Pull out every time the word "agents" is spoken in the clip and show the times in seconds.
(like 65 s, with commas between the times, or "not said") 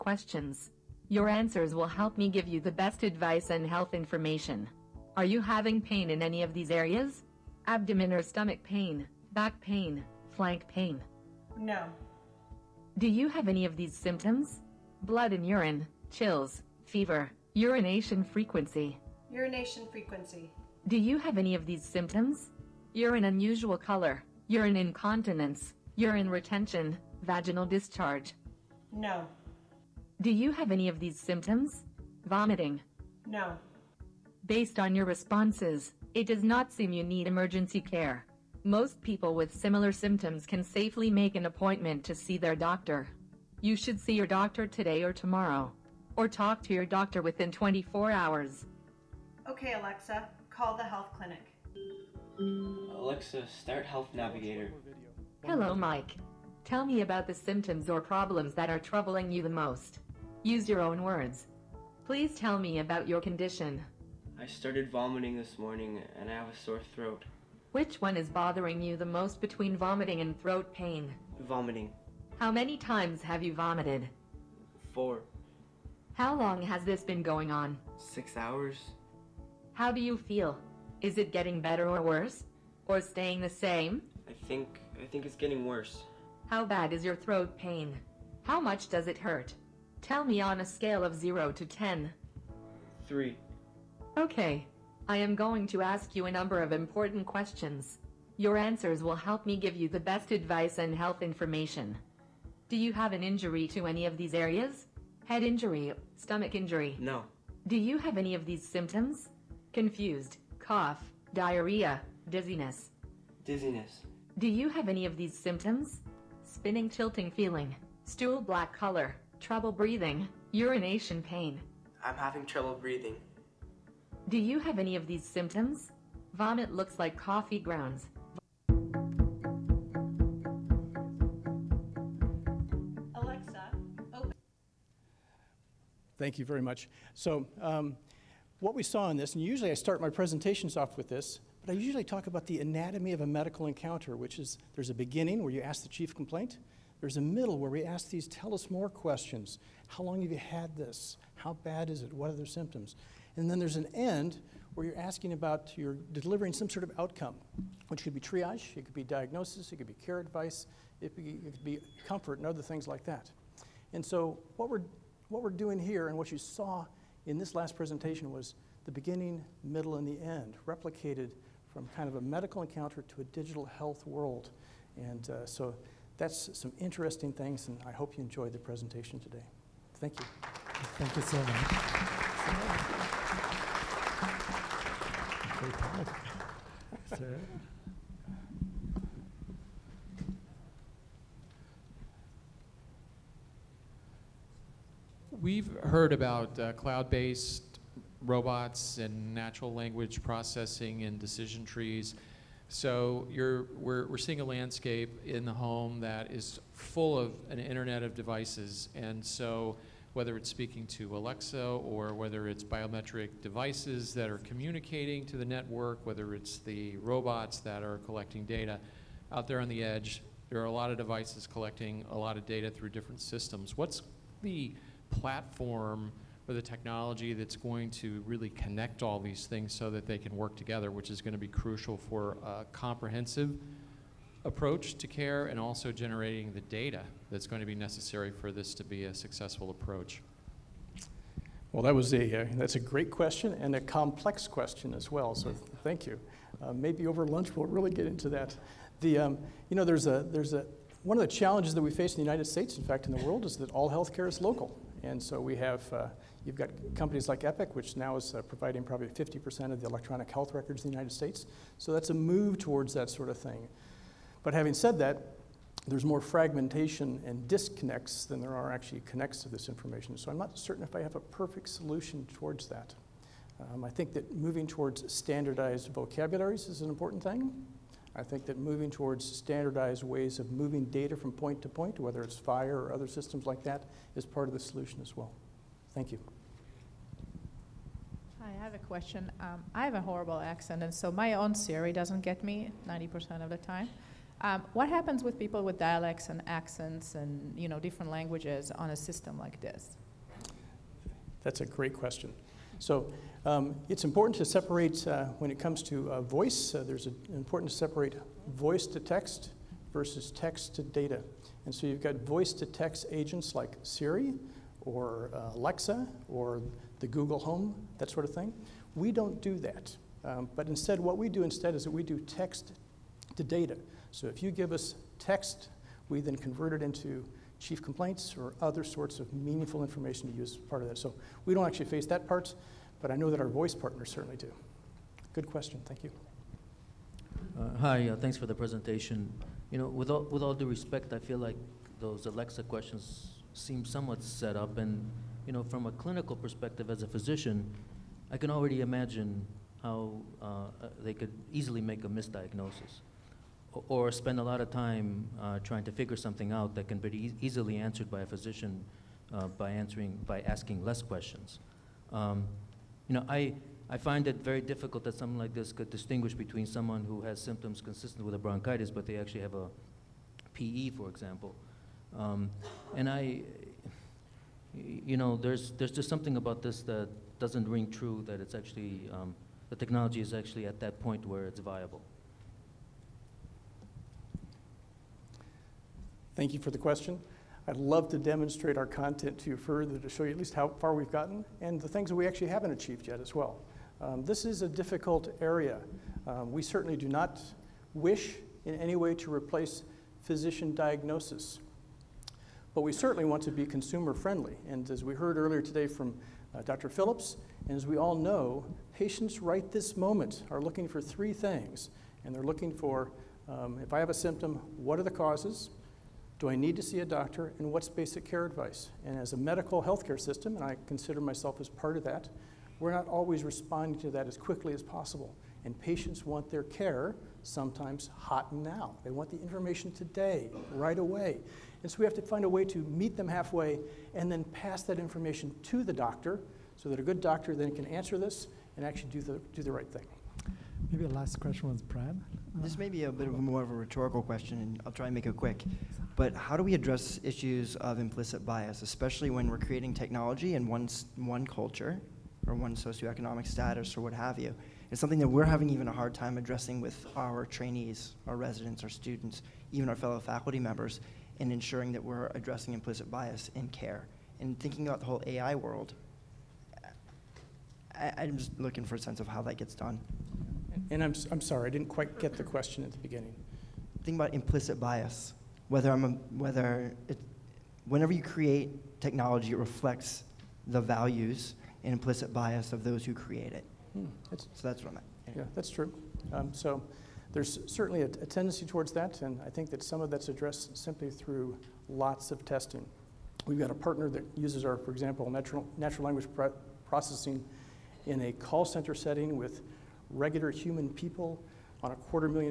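313 s.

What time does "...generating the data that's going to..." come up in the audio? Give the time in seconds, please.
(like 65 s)
235 s.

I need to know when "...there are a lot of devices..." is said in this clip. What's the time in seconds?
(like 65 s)
220 s.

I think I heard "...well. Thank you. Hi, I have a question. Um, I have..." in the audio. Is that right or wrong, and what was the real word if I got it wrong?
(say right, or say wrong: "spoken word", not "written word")
right.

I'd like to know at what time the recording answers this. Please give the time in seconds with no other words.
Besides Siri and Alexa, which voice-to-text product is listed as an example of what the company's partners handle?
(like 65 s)
317 s.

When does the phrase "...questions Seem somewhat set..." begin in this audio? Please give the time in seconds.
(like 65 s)
342 s.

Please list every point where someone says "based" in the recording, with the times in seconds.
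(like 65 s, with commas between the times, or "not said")
34 s, 196 s.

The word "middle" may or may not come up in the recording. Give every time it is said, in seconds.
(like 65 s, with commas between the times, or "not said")
147 s, 169 s.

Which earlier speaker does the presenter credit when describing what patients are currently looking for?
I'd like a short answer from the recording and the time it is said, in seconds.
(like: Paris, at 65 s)
Dr. Phillips, at 406 s.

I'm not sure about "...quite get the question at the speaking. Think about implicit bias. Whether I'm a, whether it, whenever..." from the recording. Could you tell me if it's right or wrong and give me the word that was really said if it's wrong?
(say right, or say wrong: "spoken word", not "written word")
wrong: "beginning", not "speaking".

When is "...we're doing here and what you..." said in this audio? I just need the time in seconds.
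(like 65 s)
165 s.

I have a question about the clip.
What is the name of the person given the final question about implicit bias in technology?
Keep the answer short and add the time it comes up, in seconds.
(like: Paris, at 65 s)
Brad, at 441 s.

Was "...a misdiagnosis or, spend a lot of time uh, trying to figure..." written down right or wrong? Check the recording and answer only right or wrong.
right.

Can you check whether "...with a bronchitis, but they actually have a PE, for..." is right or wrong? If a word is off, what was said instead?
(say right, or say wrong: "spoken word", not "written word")
right.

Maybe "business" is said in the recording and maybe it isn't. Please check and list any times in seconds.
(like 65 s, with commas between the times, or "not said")
not said.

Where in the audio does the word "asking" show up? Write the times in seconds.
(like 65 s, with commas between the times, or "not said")
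154 s, 360 s.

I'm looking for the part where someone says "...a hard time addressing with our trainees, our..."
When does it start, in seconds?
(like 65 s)
455 s.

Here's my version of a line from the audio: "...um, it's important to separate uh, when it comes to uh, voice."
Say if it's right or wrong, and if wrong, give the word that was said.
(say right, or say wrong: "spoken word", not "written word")
right.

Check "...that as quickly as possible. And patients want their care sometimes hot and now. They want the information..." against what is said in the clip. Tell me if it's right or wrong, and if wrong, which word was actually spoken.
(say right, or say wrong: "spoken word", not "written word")
right.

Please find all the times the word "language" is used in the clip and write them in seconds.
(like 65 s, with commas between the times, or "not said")
199 s, 298 s, 496 s.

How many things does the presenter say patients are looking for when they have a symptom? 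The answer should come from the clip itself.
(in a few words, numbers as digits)
3.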